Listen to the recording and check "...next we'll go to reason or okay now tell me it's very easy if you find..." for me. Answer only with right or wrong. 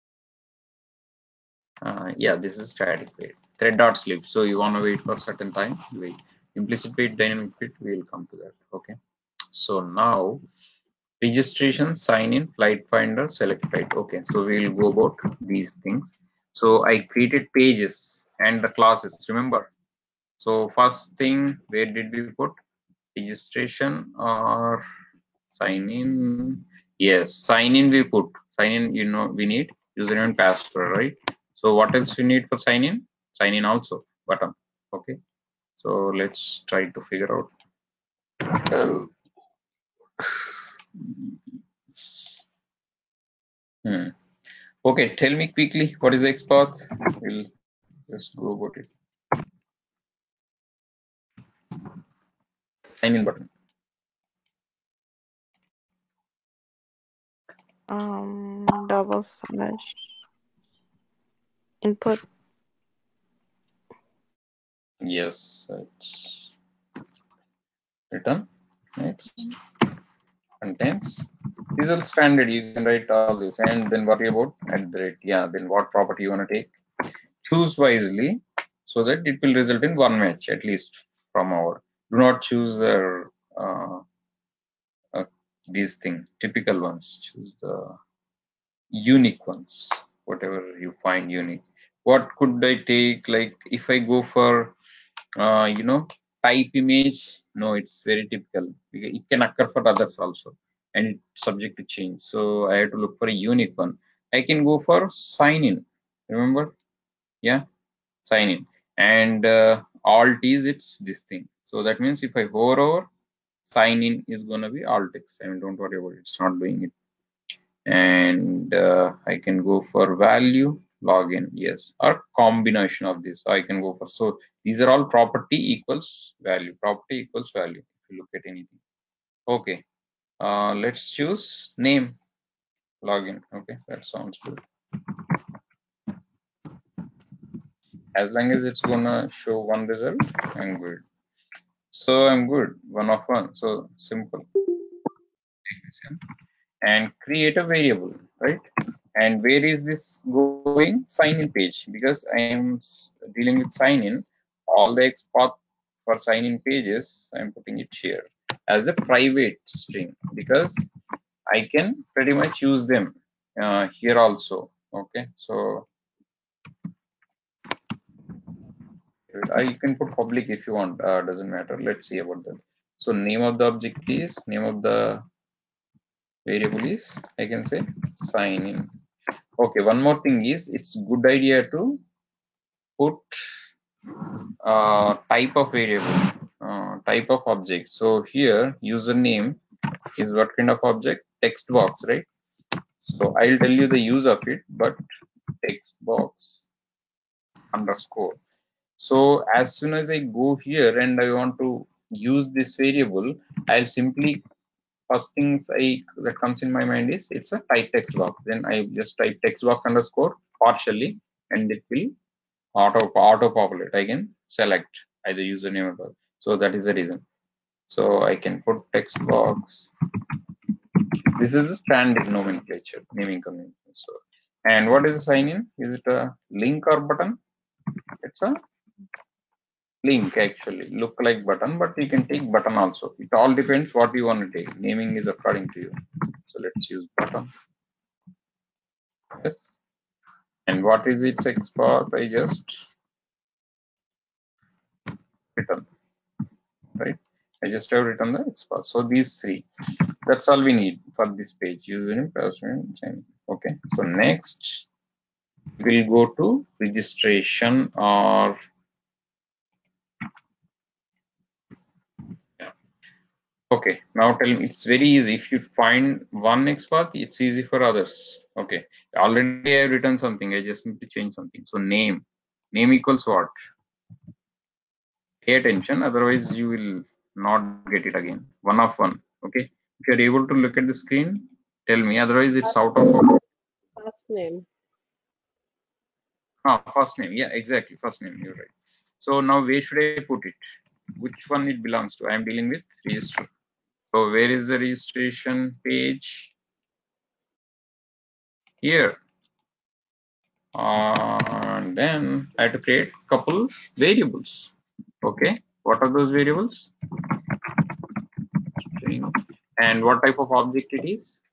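wrong.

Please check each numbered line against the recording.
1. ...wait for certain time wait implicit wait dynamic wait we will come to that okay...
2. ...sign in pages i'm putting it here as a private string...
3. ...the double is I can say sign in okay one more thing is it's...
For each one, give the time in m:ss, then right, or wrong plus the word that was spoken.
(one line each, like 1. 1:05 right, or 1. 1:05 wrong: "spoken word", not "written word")
1. 0:04 right
2. 2:36 right
3. 2:54 wrong: "variable", not "double".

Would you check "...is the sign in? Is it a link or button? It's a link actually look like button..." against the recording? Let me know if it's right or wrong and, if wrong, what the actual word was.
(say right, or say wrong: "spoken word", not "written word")
right.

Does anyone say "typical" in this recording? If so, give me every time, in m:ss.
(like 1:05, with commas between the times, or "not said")
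1:26, 1:38.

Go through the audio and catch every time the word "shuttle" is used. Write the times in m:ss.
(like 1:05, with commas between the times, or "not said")
not said.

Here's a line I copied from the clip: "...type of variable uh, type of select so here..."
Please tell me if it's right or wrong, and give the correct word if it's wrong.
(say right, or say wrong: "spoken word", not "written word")
wrong: "object", not "select".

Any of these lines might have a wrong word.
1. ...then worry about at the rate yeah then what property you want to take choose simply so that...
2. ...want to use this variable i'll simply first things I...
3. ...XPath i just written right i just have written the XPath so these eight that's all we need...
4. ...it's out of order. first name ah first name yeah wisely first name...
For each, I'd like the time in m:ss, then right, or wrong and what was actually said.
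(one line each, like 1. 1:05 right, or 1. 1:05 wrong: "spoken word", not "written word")
1. 1:13 wrong: "wisely", not "simply"
2. 3:21 right
3. 4:01 wrong: "three", not "eight"
4. 4:42 wrong: "exactly", not "wisely".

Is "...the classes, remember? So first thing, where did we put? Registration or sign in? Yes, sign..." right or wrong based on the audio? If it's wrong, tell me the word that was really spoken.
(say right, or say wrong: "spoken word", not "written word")
right.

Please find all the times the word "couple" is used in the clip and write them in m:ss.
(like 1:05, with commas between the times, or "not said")
5:03.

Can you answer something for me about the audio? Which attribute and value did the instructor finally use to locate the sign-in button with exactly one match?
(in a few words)
name login.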